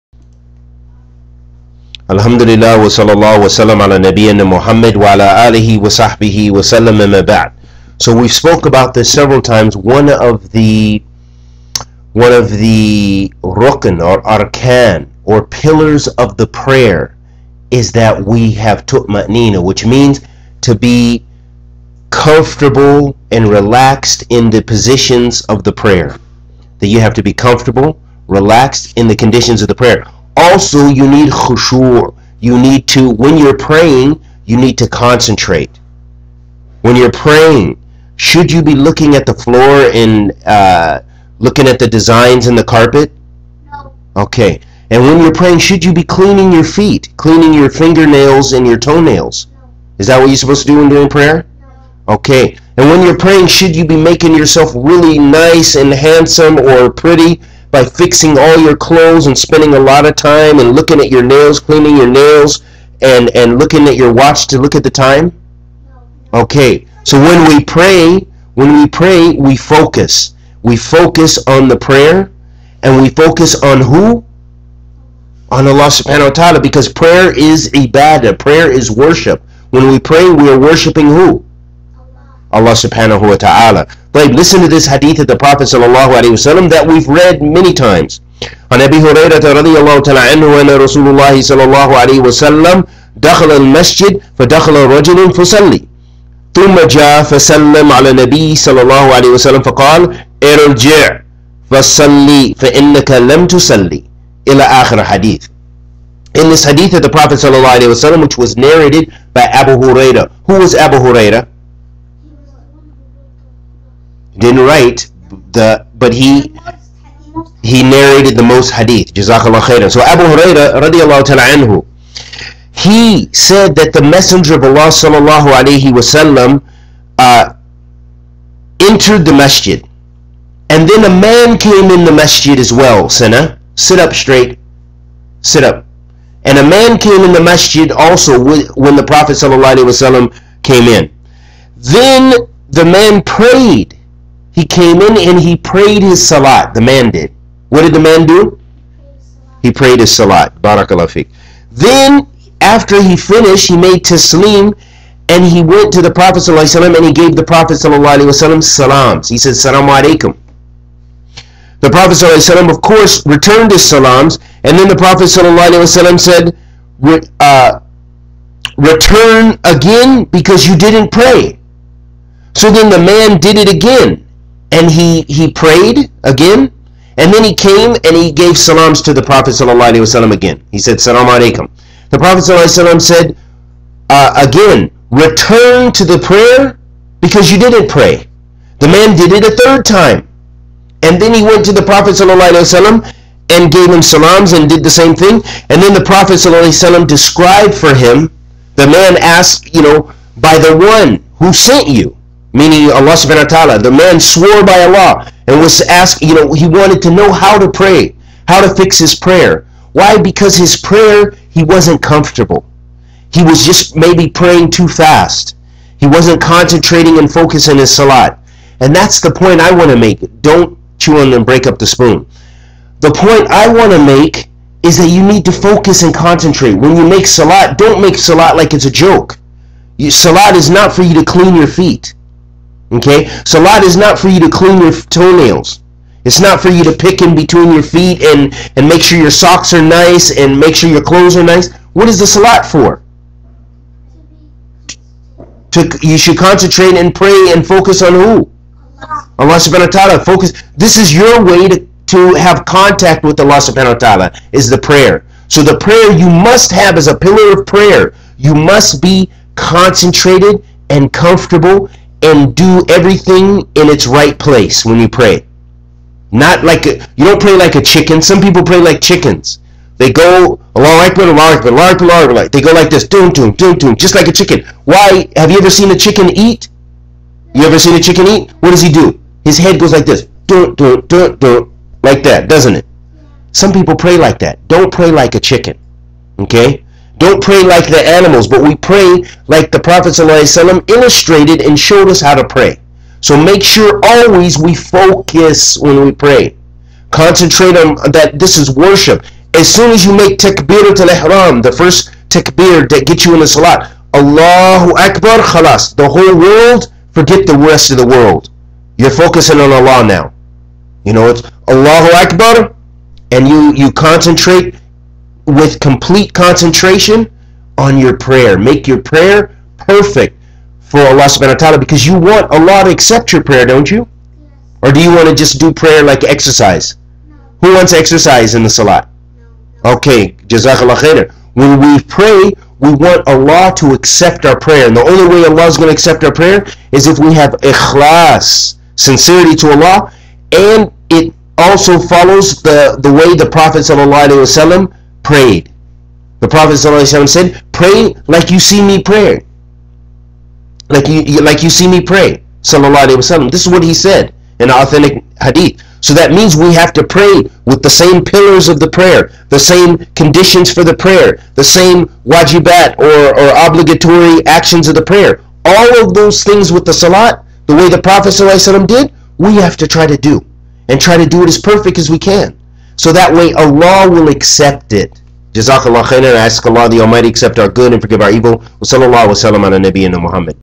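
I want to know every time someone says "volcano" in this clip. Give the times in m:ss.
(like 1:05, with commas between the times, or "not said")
not said.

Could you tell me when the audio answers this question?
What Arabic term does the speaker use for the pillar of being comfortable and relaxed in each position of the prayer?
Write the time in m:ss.
0:18.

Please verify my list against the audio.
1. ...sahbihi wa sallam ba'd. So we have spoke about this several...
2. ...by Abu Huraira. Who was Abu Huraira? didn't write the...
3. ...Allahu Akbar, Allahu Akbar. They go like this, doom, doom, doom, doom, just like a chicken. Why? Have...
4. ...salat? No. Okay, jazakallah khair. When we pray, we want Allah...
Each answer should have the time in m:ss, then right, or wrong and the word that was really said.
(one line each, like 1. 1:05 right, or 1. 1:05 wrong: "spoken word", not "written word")
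1. 0:05 right
2. 1:49 right
3. 4:31 right
4. 5:28 right.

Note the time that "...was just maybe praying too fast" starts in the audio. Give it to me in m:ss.
3:33.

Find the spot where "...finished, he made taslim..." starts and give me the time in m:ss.
2:33.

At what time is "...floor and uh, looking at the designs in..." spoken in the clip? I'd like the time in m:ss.
0:39.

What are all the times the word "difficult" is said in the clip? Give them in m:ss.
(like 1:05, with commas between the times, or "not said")
not said.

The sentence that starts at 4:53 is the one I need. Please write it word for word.
So make sure always we focus when we pray.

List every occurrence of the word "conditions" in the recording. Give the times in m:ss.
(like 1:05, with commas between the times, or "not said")
0:29, 6:00.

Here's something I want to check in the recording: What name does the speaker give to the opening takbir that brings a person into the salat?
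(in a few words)
takbir al haram.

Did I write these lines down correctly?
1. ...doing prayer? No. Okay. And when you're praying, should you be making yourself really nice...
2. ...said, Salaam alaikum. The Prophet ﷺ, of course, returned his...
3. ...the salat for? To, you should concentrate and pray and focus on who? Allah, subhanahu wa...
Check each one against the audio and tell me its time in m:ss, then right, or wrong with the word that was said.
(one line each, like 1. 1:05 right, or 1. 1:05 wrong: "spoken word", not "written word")
1. 0:50 right
2. 2:39 right
3. 4:02 right.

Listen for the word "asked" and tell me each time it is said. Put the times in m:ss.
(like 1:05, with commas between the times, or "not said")
3:19, 3:25.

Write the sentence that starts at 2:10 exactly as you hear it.
And then a man came in the masjid as well, Sinner, Sit up straight.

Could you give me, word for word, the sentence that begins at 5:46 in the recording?
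The Prophet said, pray like you see me pray.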